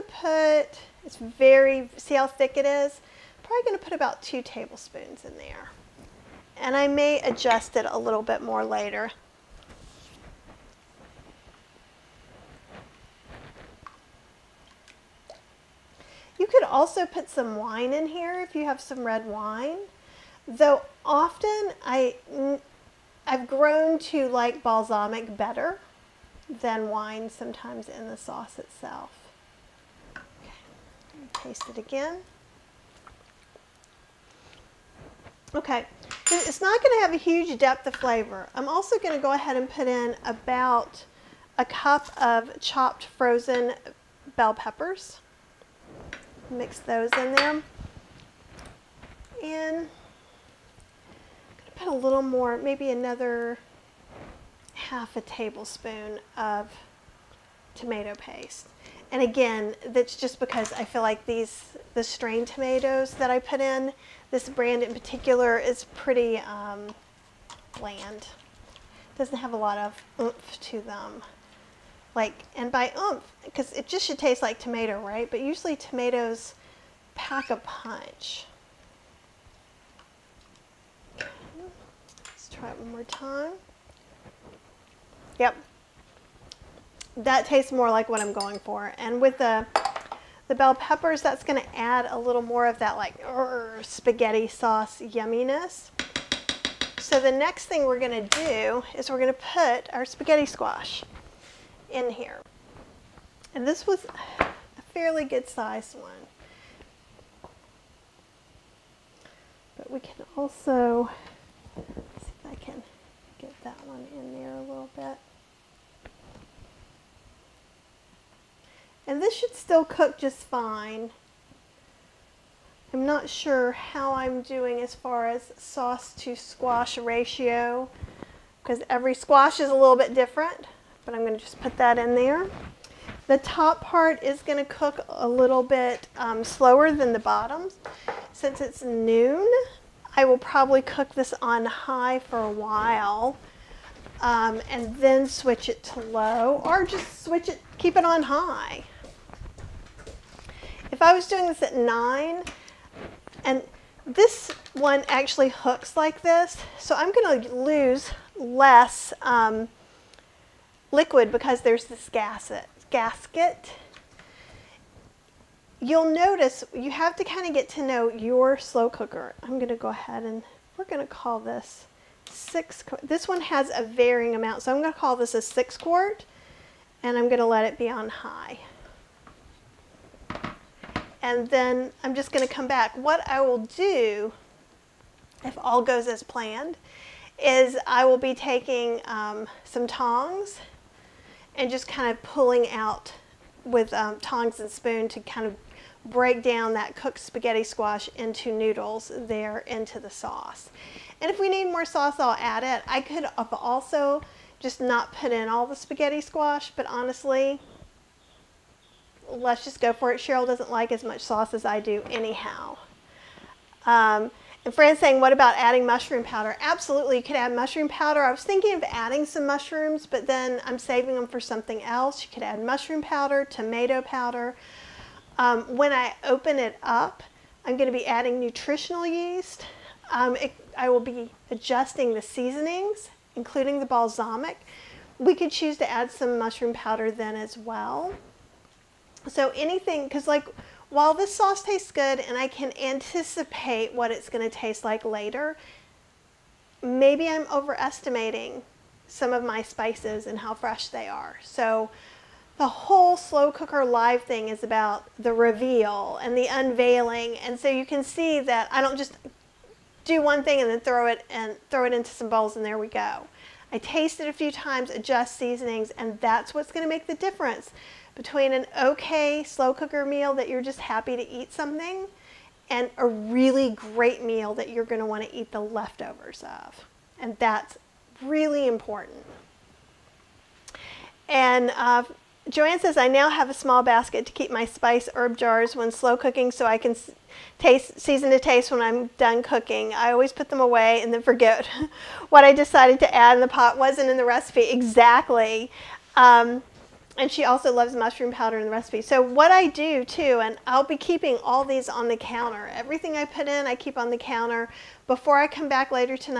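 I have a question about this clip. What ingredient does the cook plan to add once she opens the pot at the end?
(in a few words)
nutritional yeast.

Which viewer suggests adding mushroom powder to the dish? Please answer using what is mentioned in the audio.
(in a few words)
Fran.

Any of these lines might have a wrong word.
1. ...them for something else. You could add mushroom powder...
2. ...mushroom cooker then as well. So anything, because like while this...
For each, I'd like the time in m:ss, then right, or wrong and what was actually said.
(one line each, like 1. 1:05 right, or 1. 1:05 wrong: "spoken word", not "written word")
1. 3:41 right
2. 3:56 wrong: "powder", not "cooker".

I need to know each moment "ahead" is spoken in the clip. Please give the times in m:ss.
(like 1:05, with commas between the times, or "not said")
0:39, 2:49.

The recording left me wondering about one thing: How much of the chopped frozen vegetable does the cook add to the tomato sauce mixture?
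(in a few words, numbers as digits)
about a cup.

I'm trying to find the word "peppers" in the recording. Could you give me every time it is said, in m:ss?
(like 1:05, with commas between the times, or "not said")
0:44, 1:30.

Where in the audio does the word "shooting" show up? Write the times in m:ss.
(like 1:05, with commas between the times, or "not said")
not said.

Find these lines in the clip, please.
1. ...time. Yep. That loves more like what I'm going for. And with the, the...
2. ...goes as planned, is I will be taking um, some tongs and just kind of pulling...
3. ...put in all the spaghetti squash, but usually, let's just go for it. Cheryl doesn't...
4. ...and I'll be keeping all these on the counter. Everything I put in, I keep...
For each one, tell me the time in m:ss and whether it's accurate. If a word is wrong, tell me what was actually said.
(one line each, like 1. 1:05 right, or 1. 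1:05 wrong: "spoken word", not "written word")
1. 1:23 wrong: "tastes", not "loves"
2. 3:05 right
3. 3:25 wrong: "honestly", not "usually"
4. 5:00 right.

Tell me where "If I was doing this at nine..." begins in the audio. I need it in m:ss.
2:30.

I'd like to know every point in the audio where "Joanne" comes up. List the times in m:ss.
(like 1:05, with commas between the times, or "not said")
4:42.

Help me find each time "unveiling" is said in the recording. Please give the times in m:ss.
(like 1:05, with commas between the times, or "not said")
4:16.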